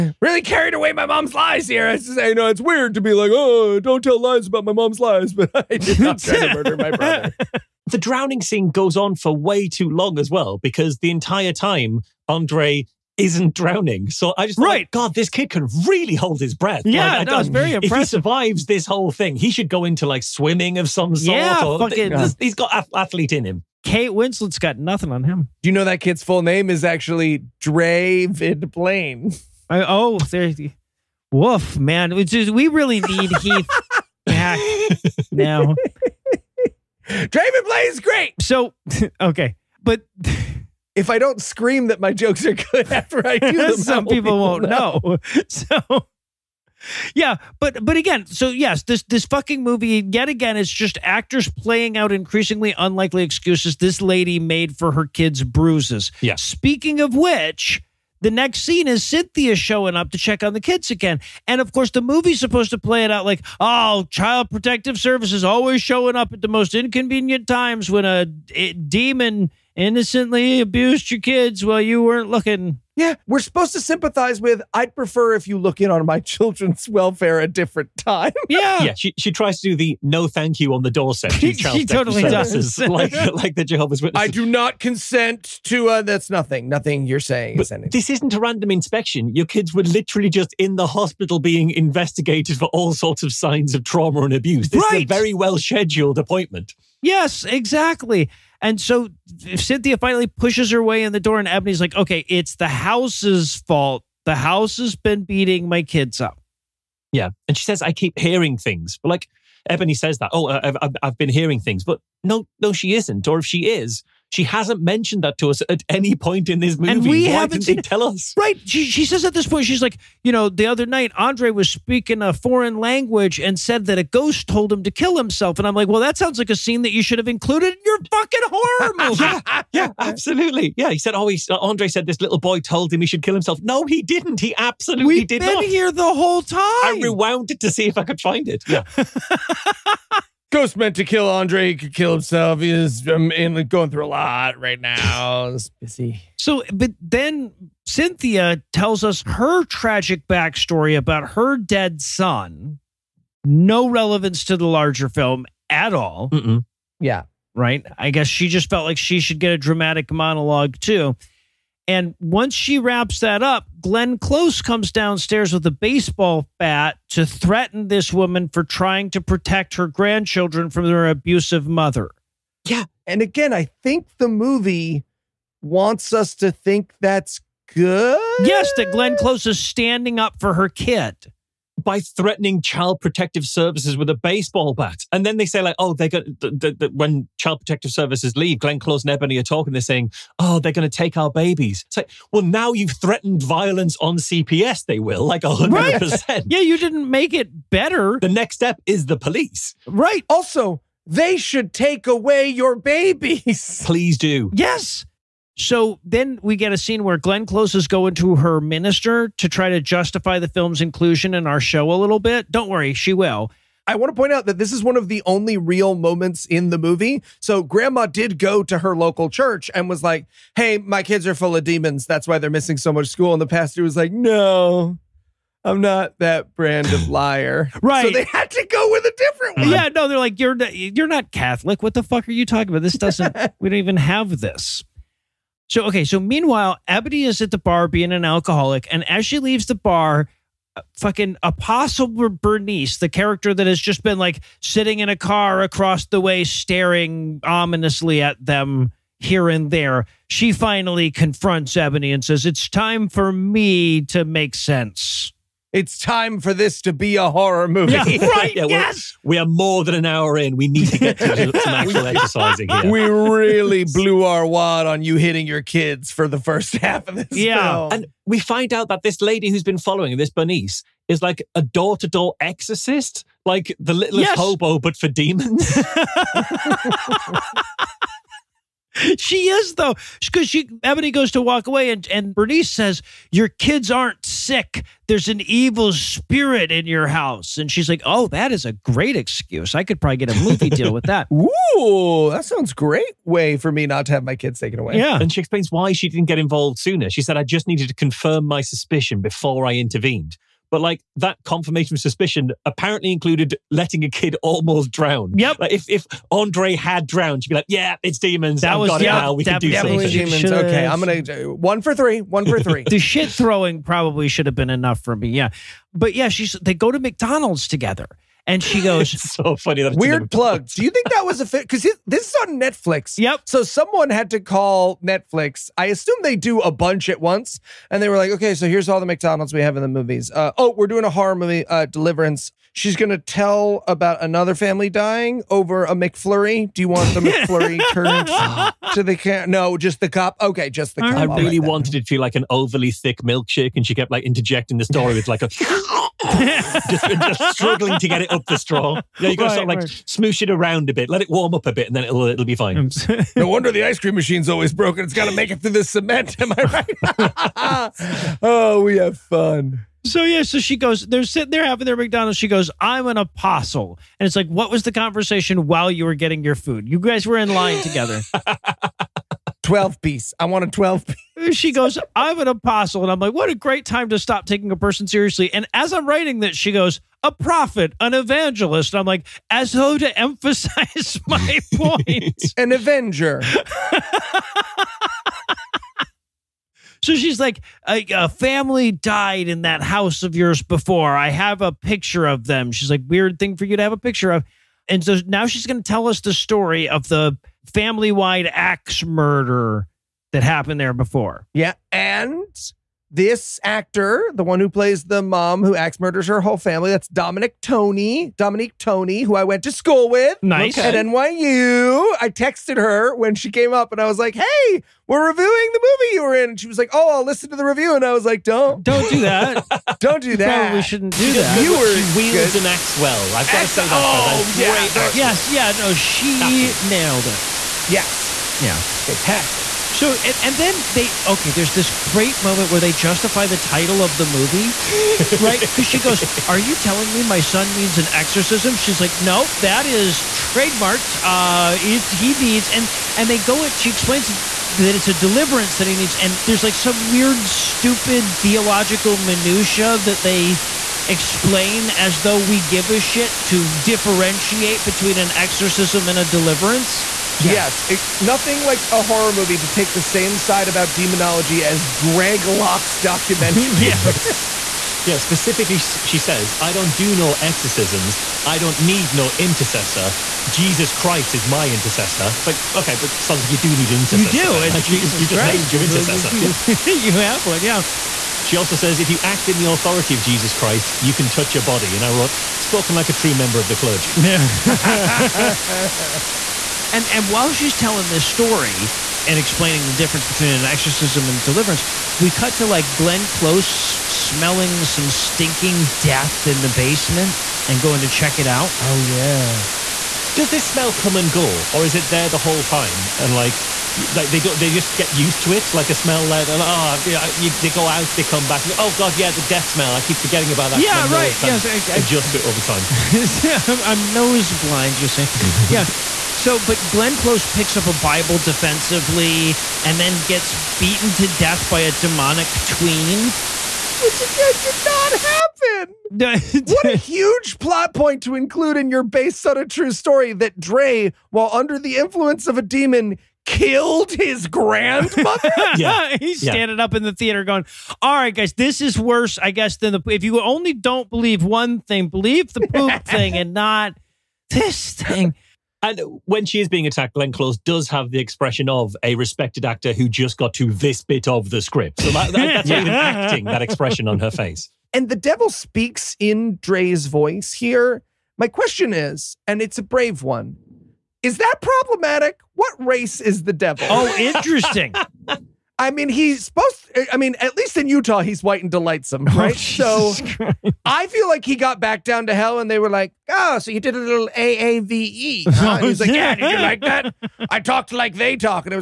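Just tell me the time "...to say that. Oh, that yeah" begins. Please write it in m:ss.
7:03.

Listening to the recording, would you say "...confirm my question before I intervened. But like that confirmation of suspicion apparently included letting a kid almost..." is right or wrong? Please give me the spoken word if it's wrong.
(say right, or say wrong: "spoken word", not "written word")
wrong: "suspicion", not "question".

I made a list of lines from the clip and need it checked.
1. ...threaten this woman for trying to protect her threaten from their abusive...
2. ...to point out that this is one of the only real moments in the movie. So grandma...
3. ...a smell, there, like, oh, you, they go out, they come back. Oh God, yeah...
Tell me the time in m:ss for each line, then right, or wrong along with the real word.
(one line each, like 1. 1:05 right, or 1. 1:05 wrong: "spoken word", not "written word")
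1. 2:47 wrong: "grandchildren", not "threaten"
2. 3:34 right
3. 8:25 right.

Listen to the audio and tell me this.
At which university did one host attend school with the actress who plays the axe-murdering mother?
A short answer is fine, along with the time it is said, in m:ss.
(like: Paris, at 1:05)
NYU, at 6:50.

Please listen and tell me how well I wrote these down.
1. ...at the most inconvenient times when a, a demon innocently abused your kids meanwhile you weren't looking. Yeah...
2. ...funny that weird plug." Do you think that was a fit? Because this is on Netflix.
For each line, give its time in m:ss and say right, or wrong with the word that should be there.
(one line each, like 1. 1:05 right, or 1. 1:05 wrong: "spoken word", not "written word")
1. 1:06 wrong: "while", not "meanwhile"
2. 5:19 right.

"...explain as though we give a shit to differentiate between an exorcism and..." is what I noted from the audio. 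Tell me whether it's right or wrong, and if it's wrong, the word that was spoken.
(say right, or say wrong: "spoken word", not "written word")
right.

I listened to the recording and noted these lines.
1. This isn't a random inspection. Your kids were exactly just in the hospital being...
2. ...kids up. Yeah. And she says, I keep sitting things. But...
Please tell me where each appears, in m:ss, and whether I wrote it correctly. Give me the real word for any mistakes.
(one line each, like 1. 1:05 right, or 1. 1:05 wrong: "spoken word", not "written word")
1. 1:27 wrong: "literally", not "exactly"
2. 1:45 wrong: "hearing", not "sitting".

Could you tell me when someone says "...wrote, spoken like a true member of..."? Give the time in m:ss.
8:02.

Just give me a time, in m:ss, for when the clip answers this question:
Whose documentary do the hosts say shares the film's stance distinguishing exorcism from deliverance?
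7:41.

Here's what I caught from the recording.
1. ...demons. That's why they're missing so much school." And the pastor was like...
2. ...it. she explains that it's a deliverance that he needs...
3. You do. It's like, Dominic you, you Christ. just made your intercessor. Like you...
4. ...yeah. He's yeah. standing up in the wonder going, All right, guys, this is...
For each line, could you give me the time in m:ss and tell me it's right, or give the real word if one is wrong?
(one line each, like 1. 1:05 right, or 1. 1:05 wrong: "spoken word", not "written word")
1. 3:41 right
2. 7:23 right
3. 7:54 wrong: "Jesus", not "Dominic"
4. 8:55 wrong: "theater", not "wonder".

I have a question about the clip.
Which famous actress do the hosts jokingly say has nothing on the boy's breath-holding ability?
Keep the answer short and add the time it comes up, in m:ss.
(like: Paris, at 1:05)
Kate Winslet, at 0:23.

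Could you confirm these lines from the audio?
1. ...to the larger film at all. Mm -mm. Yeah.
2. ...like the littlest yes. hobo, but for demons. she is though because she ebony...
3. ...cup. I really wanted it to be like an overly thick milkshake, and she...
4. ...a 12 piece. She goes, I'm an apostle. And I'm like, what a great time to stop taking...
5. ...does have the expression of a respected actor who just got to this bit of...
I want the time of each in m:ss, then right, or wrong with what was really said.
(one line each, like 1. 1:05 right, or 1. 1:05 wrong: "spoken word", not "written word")
1. 2:34 right
2. 4:33 right
3. 5:41 right
4. 6:10 right
5. 9:07 right.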